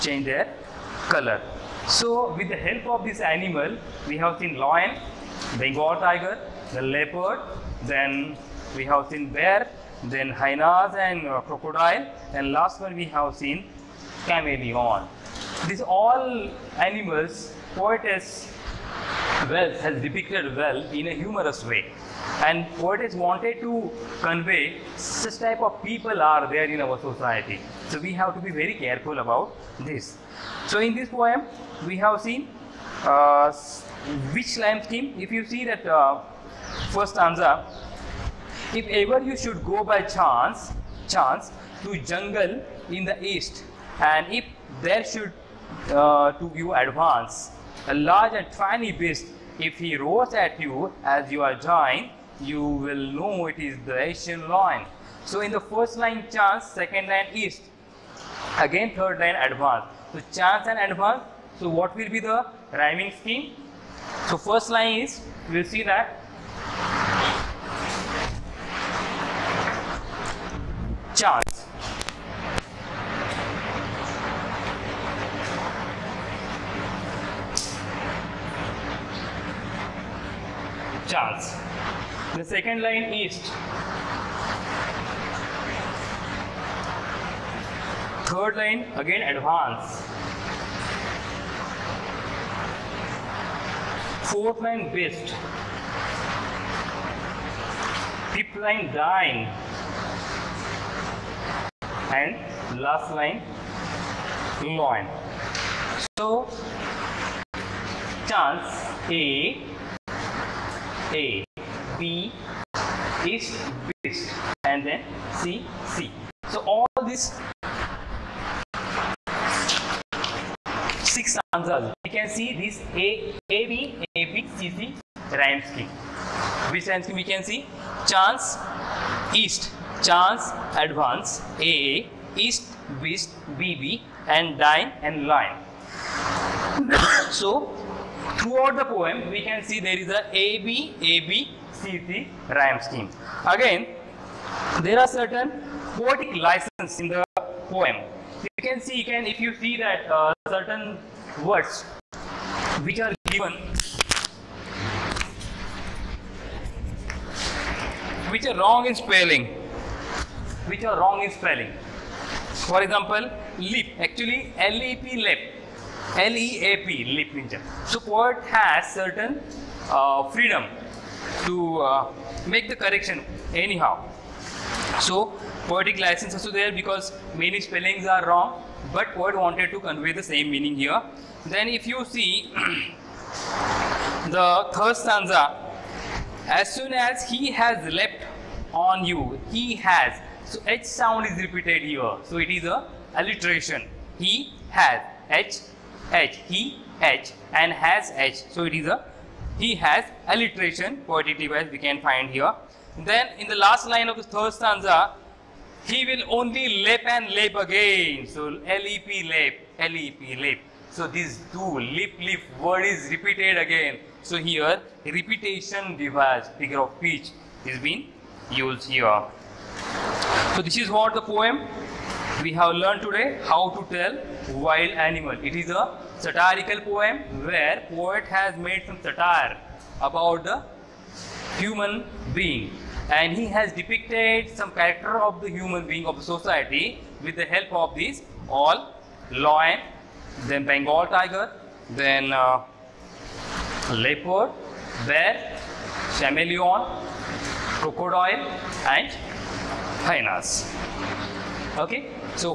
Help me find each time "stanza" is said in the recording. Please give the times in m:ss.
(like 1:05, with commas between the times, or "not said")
0:37, 3:04, 3:24.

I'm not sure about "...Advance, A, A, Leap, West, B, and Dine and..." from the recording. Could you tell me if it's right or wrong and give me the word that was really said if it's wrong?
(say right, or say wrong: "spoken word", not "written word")
wrong: "East", not "Leap".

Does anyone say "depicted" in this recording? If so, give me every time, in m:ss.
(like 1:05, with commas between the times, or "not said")
0:20, 3:53.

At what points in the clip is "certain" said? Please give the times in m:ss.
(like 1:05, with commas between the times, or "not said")
2:25, 2:30, 2:48.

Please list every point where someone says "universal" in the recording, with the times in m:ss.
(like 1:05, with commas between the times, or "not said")
not said.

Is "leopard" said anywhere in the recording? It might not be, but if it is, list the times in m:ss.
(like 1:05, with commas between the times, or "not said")
0:06, 4:03.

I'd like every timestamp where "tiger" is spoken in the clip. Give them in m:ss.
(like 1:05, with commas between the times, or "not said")
0:05, 4:01.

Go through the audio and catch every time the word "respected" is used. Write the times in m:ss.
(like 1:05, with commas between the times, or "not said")
not said.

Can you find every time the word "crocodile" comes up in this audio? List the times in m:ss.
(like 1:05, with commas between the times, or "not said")
0:11, 4:07.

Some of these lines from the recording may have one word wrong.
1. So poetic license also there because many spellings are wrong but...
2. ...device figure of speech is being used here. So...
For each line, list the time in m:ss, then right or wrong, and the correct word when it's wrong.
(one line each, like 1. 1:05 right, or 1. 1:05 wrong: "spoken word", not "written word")
1. 2:54 right
2. 3:35 right.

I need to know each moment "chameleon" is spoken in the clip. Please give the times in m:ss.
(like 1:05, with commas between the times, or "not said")
0:14, 4:06.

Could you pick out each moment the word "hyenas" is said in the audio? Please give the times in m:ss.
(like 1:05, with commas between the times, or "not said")
0:10, 4:10.